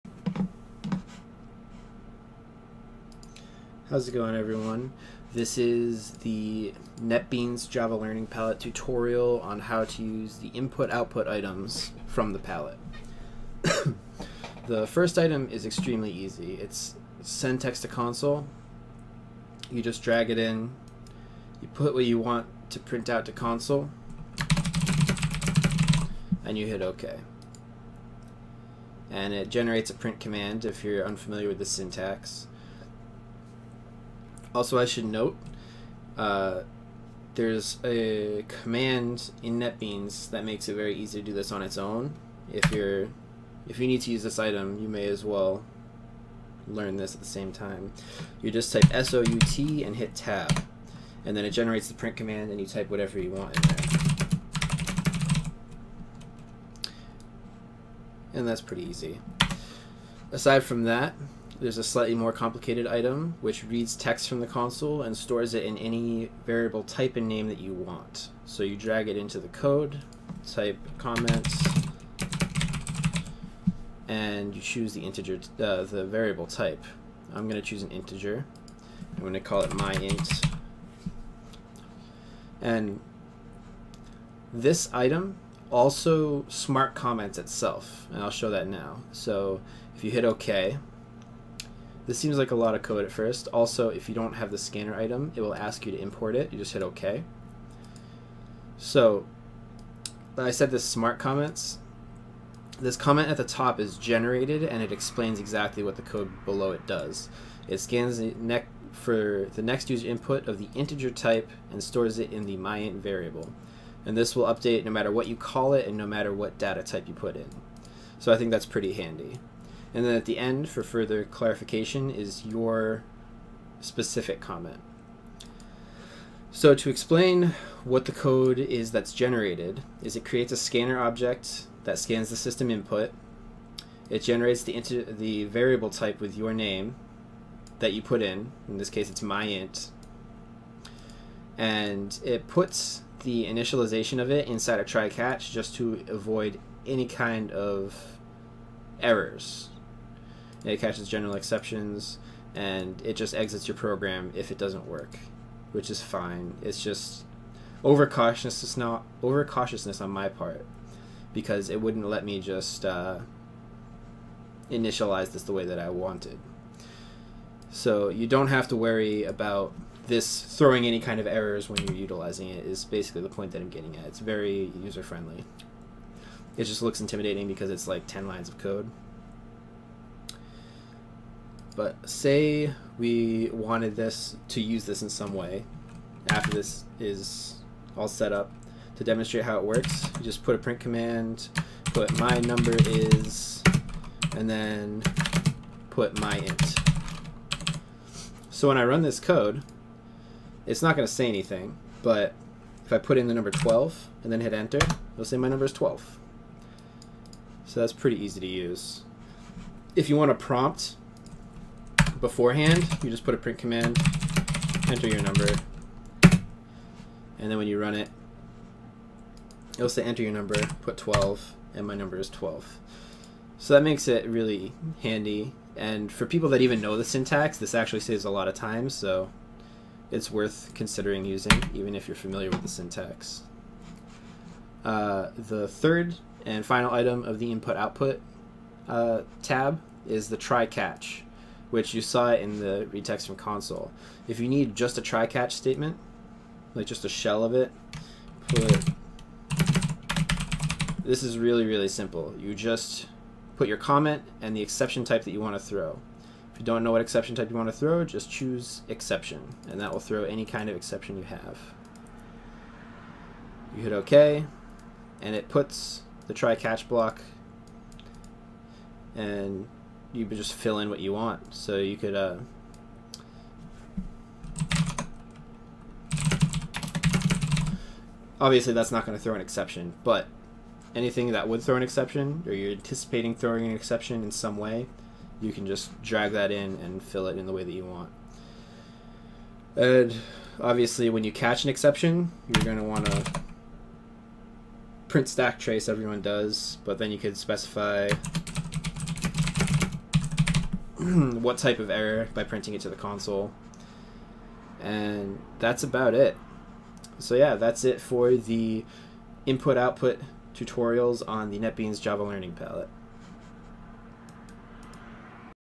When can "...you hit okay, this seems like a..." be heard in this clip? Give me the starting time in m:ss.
1:30.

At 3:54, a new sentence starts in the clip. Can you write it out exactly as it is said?
Uh, the third and final item of the input-output uh, tab is the try-catch which you saw in the retext from console.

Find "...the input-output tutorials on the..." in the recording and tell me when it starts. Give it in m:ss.
5:08.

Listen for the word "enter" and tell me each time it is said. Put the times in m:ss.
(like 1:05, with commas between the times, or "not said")
3:24, 3:34, 3:40.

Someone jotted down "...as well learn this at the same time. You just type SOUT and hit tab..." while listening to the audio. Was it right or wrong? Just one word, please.
right.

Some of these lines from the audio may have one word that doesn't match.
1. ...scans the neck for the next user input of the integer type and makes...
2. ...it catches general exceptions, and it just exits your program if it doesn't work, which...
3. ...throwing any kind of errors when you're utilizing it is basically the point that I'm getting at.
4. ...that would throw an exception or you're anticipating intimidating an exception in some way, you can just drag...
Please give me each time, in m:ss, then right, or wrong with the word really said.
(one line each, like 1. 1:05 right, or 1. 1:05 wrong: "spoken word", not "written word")
1. 1:47 wrong: "stores", not "makes"
2. 2:30 right
3. 2:50 right
4. 4:41 wrong: "throwing", not "intimidating".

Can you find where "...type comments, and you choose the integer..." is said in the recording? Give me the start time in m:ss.
1:10.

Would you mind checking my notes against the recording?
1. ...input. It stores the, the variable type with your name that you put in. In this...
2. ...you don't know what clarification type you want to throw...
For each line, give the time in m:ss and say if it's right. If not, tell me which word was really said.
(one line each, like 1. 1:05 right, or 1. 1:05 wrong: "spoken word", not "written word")
1. 2:12 wrong: "generates", not "stores"
2. 4:16 wrong: "exception", not "clarification".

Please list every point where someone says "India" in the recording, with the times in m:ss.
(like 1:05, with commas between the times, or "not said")
not said.